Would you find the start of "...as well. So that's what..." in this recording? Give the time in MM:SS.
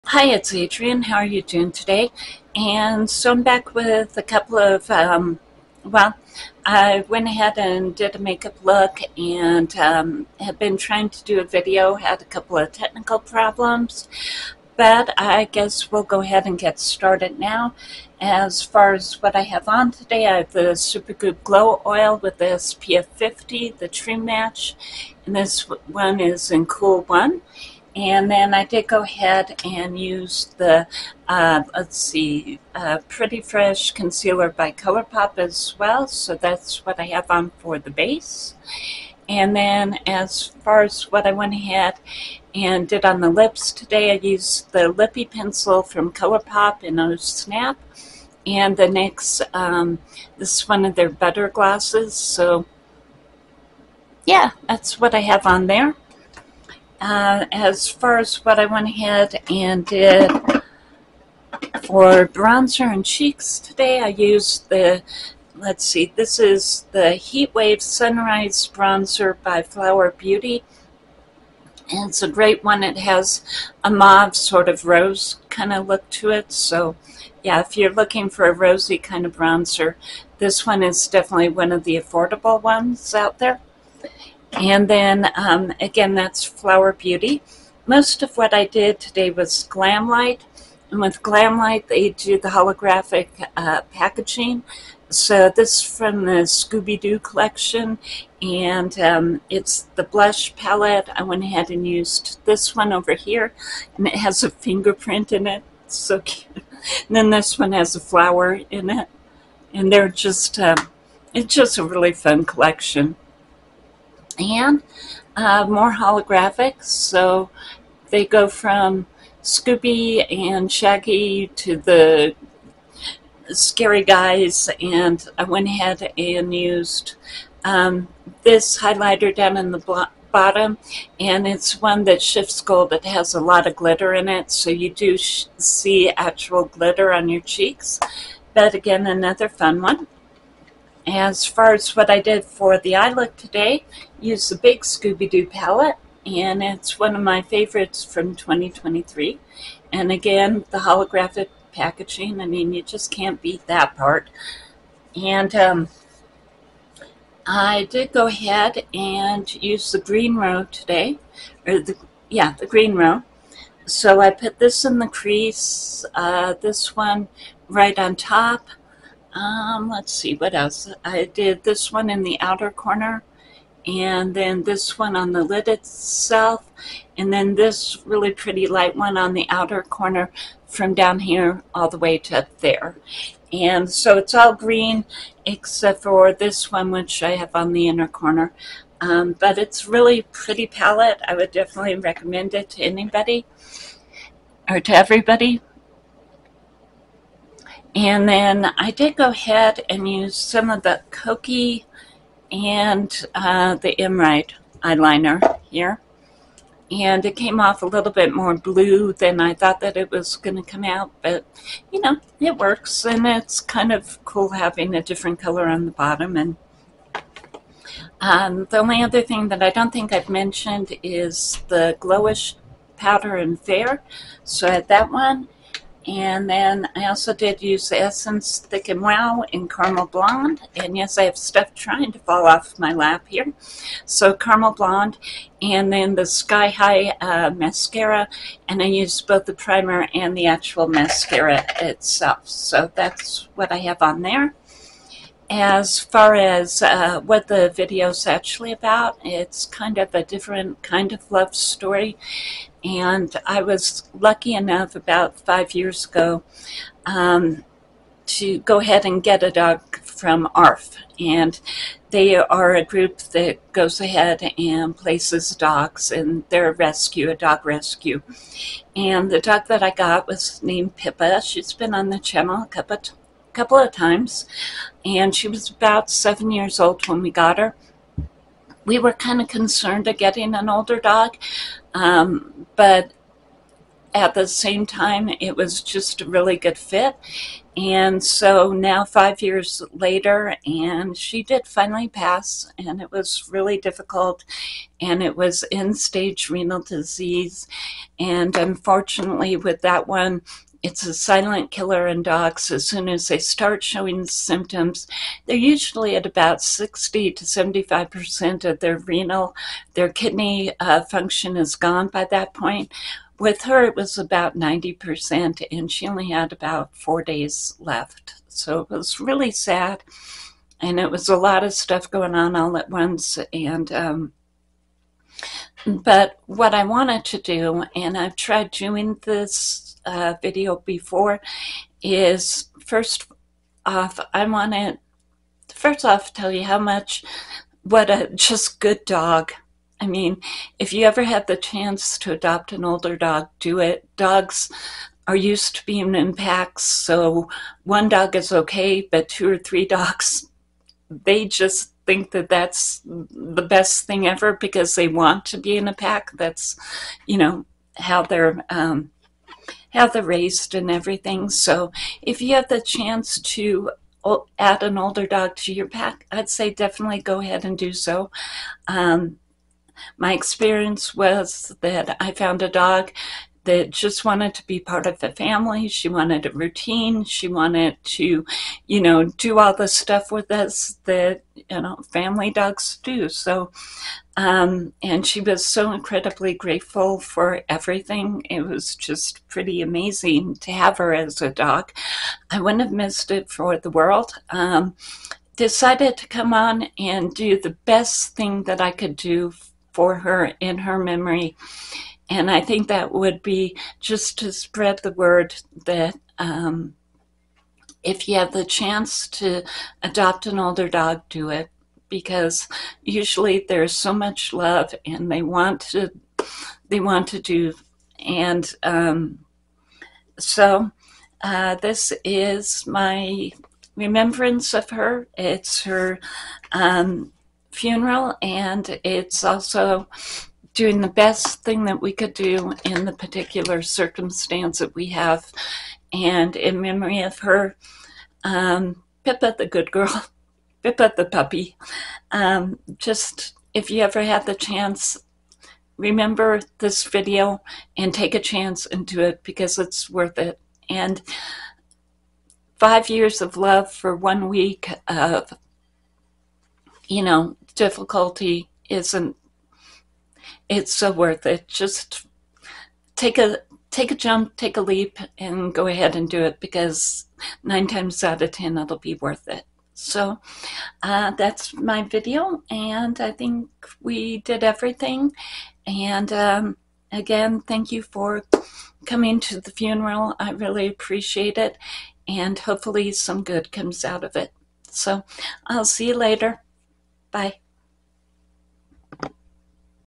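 00:35.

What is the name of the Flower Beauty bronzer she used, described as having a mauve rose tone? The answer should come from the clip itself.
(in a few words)
Heatwave Sunrise.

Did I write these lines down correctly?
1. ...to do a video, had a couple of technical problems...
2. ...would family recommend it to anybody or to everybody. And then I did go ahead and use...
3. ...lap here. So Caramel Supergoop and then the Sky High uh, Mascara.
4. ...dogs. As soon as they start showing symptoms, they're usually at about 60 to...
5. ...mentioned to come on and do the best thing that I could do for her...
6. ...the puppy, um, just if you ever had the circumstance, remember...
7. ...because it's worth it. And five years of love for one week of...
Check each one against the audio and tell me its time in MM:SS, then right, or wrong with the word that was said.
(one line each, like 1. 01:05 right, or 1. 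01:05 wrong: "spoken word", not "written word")
1. 00:11 right
2. 03:11 wrong: "definitely", not "family"
3. 03:52 wrong: "Blonde", not "Supergoop"
4. 05:02 right
5. 06:35 wrong: "decided", not "mentioned"
6. 07:21 wrong: "chance", not "circumstance"
7. 07:29 right.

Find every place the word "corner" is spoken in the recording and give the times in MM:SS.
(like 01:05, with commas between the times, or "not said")
02:52, 02:59, 03:08.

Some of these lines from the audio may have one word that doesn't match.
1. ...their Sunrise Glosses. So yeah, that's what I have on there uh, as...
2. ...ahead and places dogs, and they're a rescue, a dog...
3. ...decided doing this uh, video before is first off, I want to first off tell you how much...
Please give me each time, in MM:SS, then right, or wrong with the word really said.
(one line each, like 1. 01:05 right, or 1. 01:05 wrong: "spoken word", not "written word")
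1. 00:50 wrong: "Butter", not "Sunrise"
2. 04:23 right
3. 05:28 wrong: "tried", not "decided".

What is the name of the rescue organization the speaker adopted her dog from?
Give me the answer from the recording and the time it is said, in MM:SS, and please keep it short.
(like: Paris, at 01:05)
ARF, at 04:20.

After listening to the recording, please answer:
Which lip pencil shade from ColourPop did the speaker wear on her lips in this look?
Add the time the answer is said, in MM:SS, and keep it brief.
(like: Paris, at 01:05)
O Snap, at 00:46.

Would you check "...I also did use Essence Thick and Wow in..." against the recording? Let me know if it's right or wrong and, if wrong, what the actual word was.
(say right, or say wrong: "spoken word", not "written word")
right.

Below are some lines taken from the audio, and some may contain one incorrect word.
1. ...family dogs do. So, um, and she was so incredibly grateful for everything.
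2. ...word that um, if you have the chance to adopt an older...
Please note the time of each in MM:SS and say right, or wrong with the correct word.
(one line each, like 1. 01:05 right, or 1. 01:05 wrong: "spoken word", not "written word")
1. 06:22 right
2. 06:45 right.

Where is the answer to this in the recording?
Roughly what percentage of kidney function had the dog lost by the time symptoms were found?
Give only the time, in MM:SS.
05:14.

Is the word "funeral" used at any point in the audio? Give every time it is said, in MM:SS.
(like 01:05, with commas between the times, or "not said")
07:07, 07:59.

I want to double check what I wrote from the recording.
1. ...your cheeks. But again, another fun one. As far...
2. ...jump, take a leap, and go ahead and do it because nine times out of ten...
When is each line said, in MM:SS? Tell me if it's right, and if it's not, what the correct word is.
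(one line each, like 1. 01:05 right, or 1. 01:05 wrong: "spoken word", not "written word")
1. 02:17 right
2. 07:44 right.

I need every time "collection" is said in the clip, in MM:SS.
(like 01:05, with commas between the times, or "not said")
01:37, 01:52.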